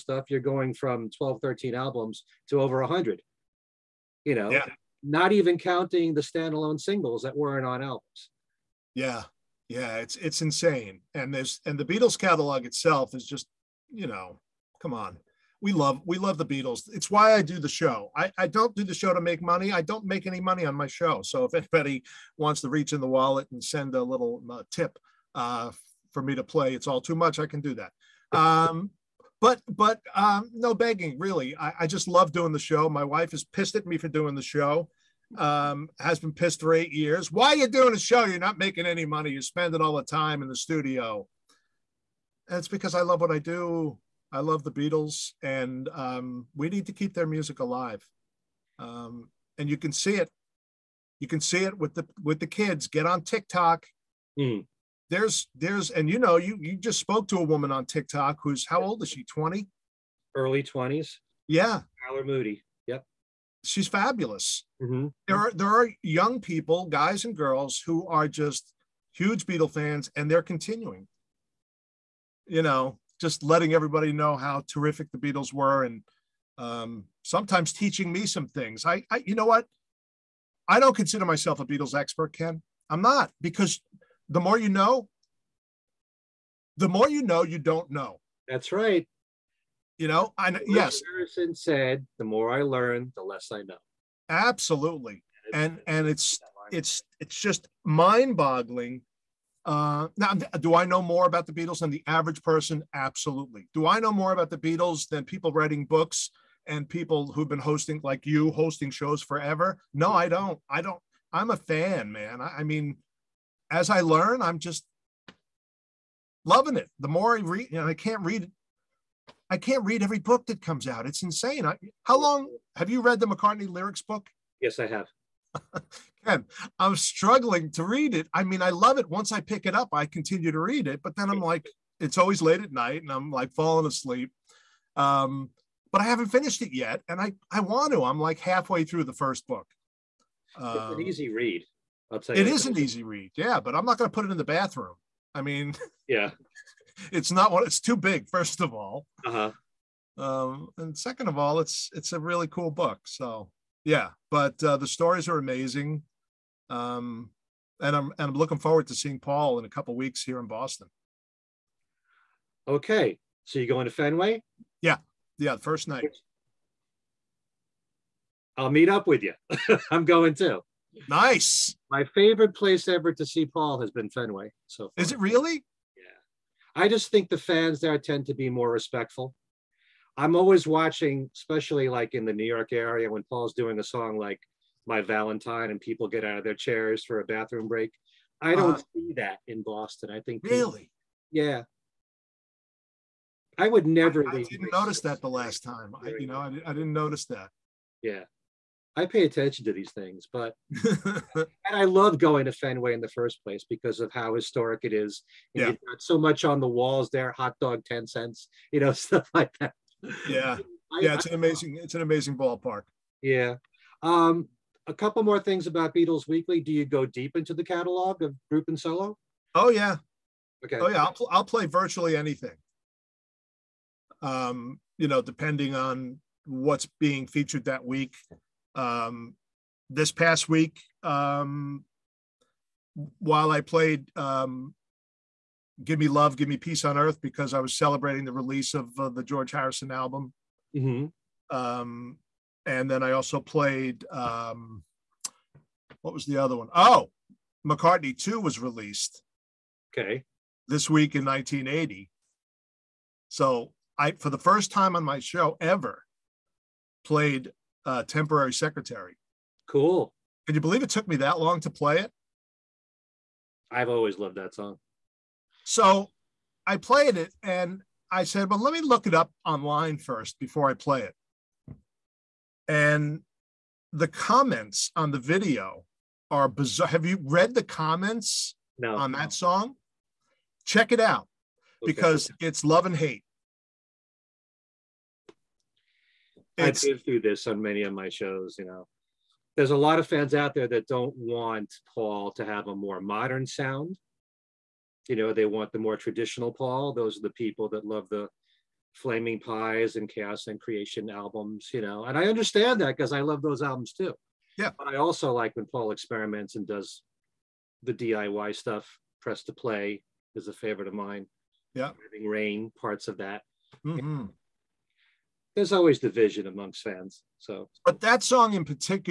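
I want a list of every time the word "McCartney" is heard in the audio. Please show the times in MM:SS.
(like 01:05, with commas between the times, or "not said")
02:03, 04:07.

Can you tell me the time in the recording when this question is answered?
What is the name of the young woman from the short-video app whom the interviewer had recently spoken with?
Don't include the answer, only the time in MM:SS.
01:02.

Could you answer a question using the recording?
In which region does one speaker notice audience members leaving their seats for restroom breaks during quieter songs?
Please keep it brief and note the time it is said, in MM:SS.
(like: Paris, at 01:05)
New York area, at 03:02.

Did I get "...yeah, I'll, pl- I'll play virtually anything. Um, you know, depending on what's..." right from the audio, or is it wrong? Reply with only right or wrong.
right.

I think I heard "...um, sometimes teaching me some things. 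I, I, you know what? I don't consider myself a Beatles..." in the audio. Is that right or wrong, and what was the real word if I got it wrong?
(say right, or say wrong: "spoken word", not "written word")
right.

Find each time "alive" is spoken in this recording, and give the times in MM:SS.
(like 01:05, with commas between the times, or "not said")
00:47.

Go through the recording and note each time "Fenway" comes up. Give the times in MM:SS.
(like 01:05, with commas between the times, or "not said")
02:43, 02:54, 03:22.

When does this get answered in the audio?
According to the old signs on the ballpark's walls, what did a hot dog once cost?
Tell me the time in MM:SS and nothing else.
03:27.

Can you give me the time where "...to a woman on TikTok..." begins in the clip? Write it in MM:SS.
00:57.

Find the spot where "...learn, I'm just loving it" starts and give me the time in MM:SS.
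01:54.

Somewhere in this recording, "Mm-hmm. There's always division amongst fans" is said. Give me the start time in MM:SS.
05:13.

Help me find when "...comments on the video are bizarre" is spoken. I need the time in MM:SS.
04:34.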